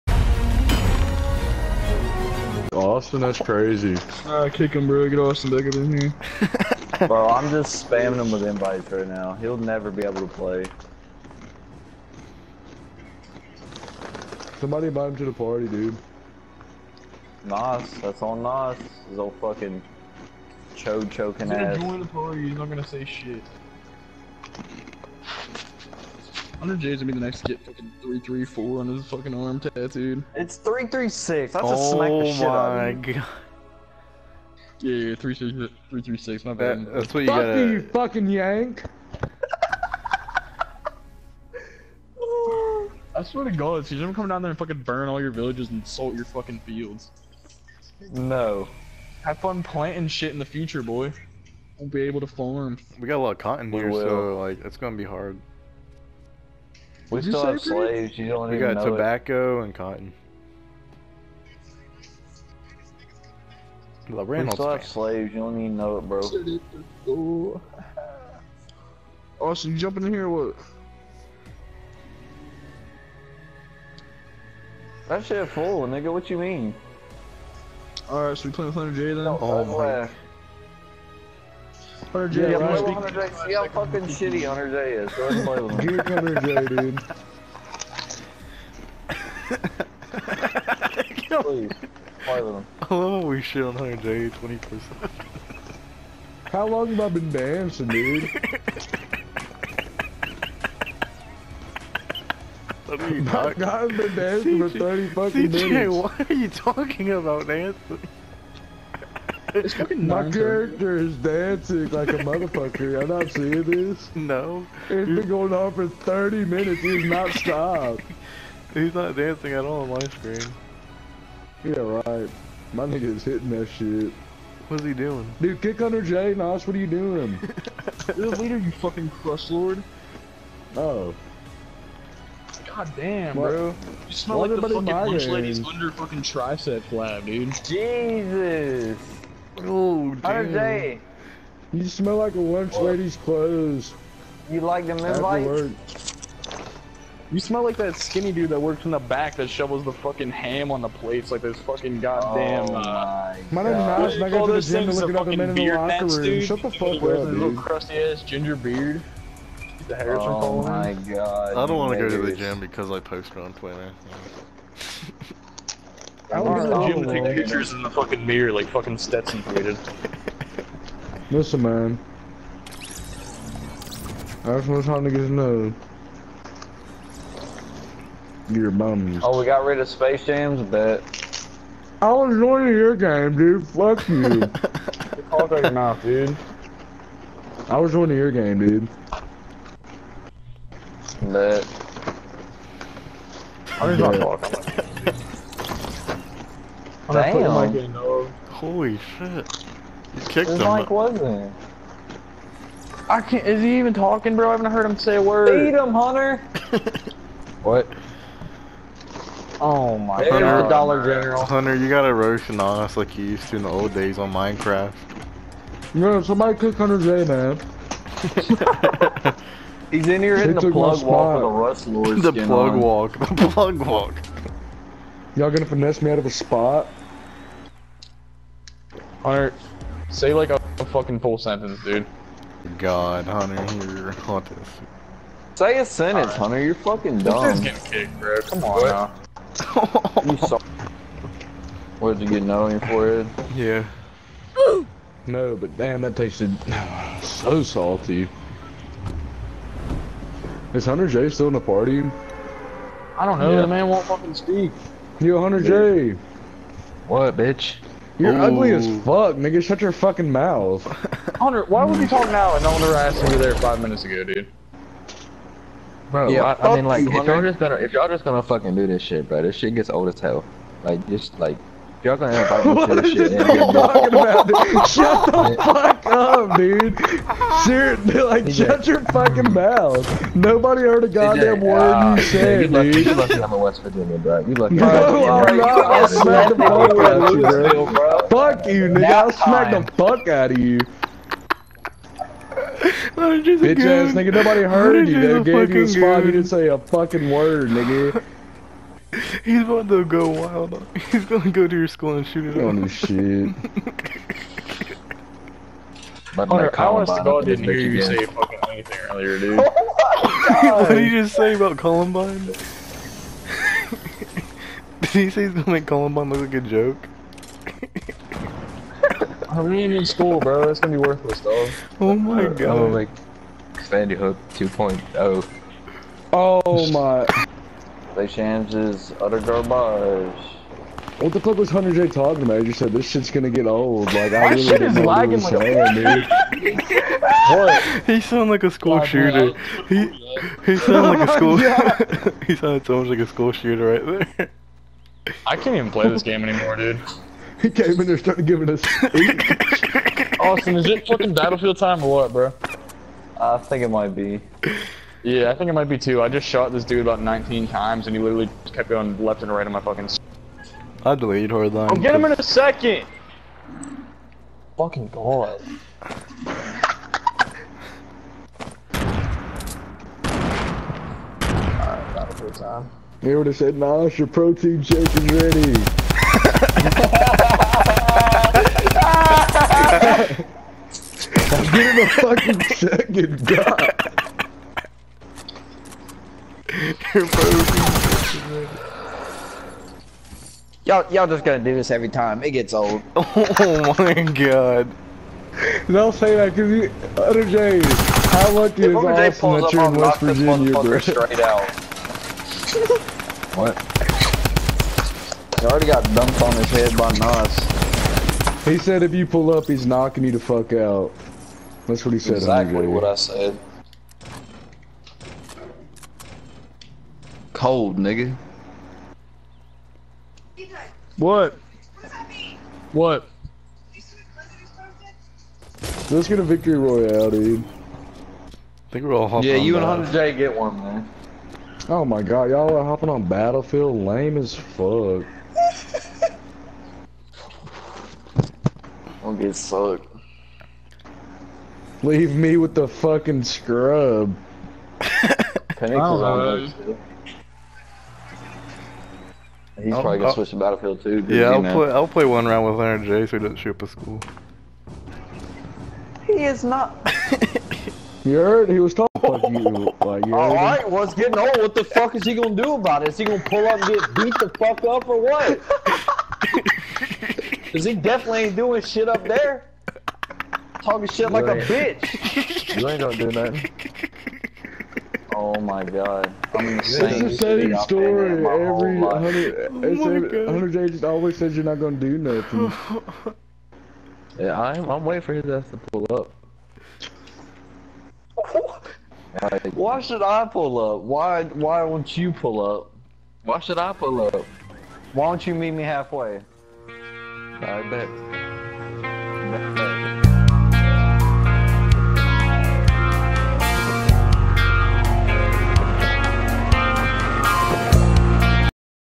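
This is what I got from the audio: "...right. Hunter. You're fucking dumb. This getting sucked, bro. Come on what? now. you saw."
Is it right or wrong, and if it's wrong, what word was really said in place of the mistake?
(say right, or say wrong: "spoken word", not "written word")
wrong: "kicked", not "sucked".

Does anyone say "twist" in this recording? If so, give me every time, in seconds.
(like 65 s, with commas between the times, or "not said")
not said.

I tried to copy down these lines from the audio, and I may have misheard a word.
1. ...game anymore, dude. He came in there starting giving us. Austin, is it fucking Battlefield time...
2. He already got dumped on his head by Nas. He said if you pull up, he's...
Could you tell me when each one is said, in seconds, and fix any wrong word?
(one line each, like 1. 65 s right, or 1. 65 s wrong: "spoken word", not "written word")
1. 346 s right
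2. 405 s right.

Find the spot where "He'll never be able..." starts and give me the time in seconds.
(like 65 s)
9 s.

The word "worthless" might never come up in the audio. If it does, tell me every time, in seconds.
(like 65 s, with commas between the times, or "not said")
321 s.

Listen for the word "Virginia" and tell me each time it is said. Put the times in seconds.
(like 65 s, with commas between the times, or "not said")
283 s, 400 s.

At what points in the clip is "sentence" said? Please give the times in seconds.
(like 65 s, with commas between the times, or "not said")
231 s, 235 s.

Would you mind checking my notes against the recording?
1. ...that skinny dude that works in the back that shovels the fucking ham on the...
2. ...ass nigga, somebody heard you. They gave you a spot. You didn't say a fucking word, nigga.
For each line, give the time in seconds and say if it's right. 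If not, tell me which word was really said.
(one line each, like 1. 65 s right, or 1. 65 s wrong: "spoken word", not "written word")
1. 147 s right
2. 293 s wrong: "nobody", not "somebody".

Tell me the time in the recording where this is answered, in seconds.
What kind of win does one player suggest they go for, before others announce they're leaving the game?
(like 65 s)
426 s.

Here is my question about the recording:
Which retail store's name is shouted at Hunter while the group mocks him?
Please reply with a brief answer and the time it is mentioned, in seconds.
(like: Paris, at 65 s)
Dollar General, at 210 s.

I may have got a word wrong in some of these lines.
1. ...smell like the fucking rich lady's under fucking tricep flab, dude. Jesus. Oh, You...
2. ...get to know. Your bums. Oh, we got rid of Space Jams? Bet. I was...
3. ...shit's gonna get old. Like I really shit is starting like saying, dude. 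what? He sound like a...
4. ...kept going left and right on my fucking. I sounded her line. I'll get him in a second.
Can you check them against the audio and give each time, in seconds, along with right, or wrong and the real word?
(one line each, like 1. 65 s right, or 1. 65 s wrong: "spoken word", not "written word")
1. 134 s right
2. 175 s right
3. 333 s wrong: "lagging", not "starting"
4. 358 s wrong: "deleted", not "sounded".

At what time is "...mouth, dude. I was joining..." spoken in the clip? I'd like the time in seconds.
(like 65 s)
185 s.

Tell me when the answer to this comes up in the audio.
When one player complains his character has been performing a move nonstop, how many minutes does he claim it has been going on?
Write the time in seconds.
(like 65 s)
104 s.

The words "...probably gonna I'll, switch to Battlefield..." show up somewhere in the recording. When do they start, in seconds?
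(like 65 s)
450 s.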